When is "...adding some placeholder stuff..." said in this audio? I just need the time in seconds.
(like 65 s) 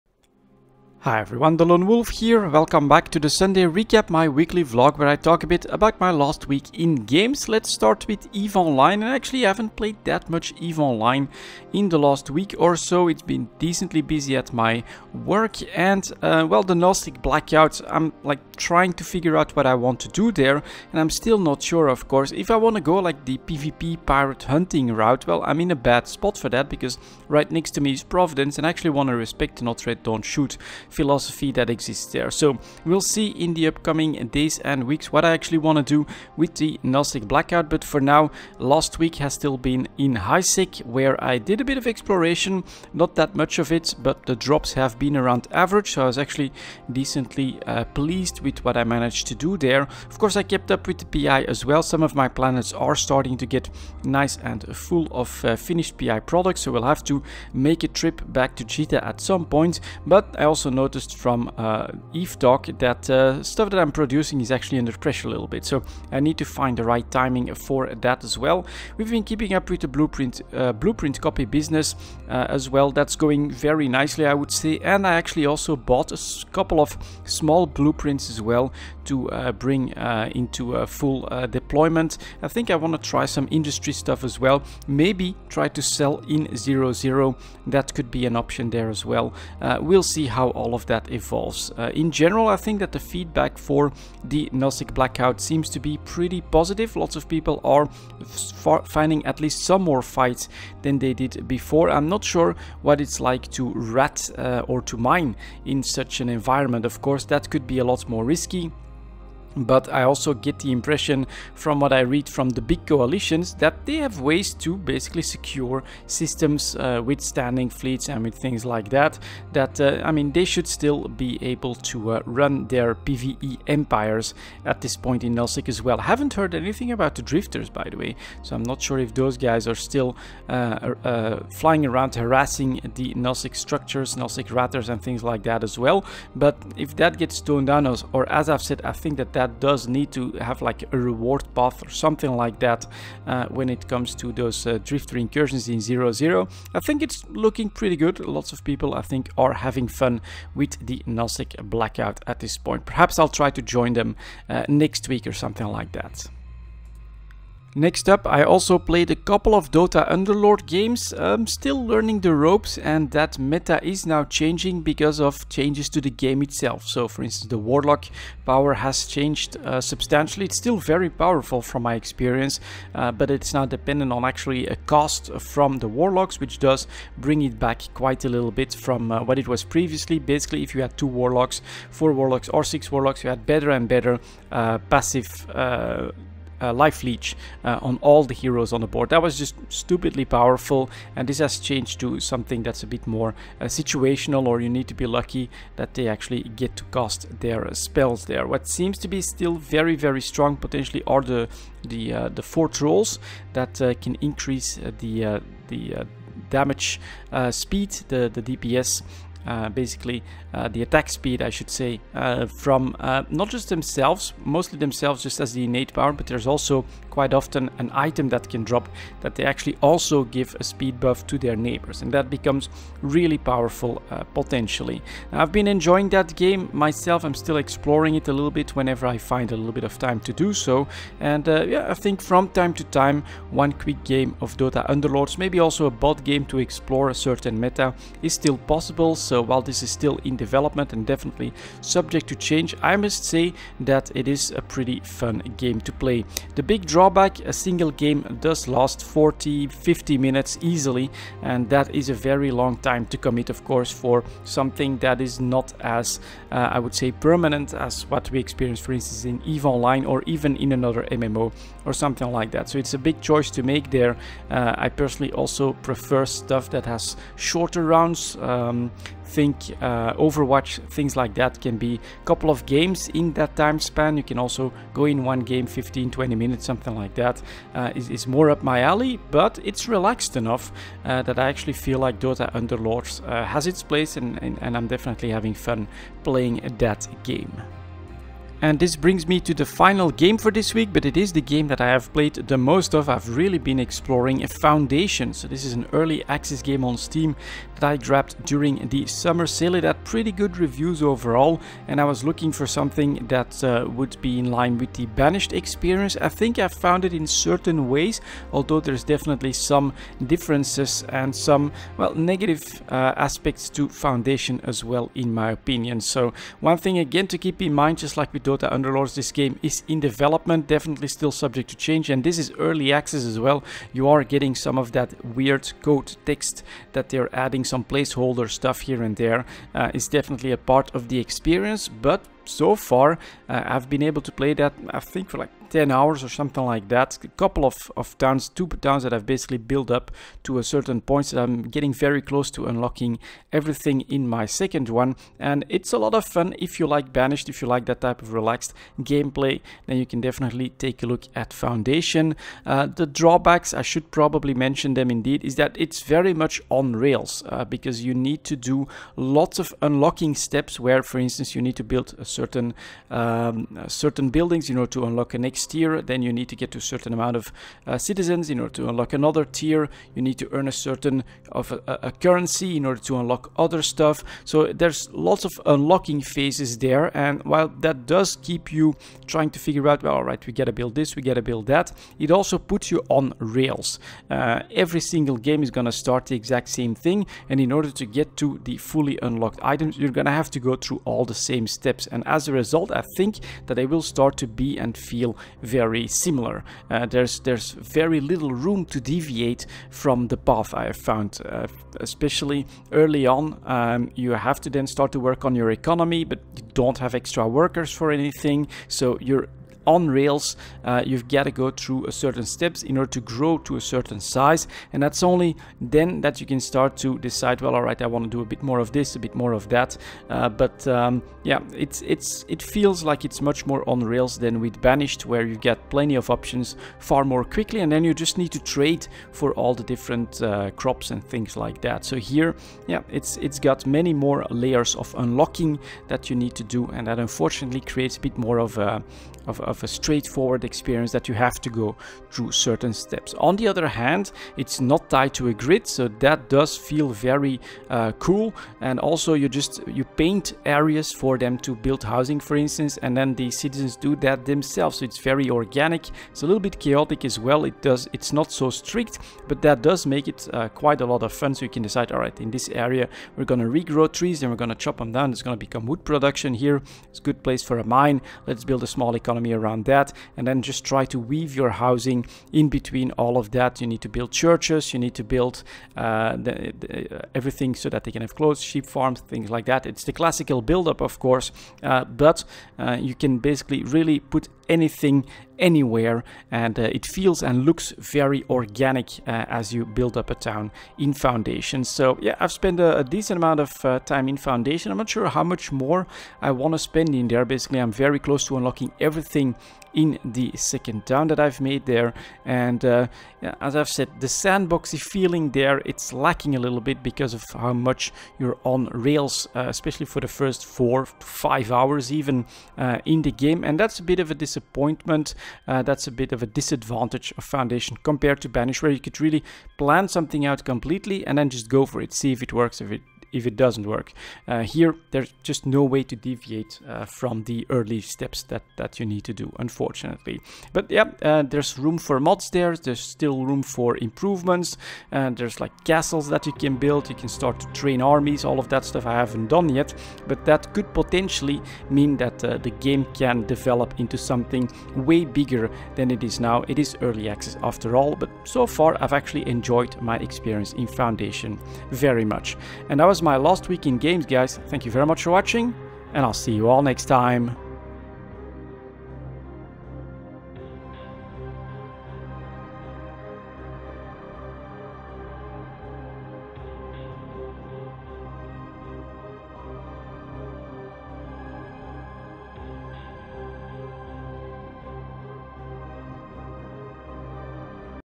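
327 s.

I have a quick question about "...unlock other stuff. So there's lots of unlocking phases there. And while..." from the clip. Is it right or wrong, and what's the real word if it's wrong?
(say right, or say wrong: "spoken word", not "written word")
right.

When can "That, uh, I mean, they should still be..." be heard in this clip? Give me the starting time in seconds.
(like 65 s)
119 s.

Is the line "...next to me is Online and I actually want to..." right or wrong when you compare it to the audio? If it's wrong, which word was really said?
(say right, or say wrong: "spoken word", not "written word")
wrong: "Providence", not "Online".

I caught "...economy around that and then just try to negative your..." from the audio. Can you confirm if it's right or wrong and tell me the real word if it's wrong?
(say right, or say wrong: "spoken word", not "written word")
wrong: "weave", not "negative".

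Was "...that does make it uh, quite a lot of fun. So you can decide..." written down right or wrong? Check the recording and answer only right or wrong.
right.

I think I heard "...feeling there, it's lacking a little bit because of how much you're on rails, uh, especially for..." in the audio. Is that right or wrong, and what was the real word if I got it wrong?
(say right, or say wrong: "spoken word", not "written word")
right.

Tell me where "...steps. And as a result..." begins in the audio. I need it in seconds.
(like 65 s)
391 s.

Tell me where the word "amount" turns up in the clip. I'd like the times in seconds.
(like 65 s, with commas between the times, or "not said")
367 s, 493 s.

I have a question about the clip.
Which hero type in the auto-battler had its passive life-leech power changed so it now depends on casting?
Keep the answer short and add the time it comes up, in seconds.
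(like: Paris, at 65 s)
Warlock, at 167 s.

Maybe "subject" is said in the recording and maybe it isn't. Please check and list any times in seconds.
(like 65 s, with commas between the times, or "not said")
241 s, 321 s.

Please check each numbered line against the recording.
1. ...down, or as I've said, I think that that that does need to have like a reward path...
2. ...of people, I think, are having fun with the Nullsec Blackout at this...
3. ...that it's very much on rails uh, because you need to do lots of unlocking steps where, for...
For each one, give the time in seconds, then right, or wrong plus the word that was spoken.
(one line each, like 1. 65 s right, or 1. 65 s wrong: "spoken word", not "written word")
1. 137 s right
2. 148 s right
3. 355 s right.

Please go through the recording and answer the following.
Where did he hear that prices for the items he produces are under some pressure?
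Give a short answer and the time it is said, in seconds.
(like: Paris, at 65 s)
Eve Talk, at 62 s.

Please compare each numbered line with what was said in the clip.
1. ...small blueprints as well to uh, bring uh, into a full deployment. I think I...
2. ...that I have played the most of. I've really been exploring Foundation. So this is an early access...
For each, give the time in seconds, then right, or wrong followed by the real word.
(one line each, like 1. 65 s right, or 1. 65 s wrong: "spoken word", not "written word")
1. 77 s right
2. 291 s right.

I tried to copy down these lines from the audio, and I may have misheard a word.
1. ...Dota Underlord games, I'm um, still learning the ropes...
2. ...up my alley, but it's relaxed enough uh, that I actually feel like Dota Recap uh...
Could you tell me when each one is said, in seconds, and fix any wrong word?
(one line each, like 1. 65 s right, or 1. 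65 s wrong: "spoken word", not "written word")
1. 159 s right
2. 278 s wrong: "Underlords", not "Recap".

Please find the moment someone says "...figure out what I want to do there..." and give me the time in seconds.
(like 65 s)
19 s.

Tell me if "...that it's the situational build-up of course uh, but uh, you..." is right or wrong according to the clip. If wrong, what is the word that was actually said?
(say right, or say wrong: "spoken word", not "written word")
wrong: "classical", not "situational".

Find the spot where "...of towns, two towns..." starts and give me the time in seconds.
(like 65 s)
337 s.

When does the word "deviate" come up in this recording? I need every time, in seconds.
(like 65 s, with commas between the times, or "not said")
399 s, 526 s.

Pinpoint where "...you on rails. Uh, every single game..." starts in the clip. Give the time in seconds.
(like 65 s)
382 s.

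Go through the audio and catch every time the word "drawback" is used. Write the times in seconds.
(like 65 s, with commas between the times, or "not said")
246 s, 353 s.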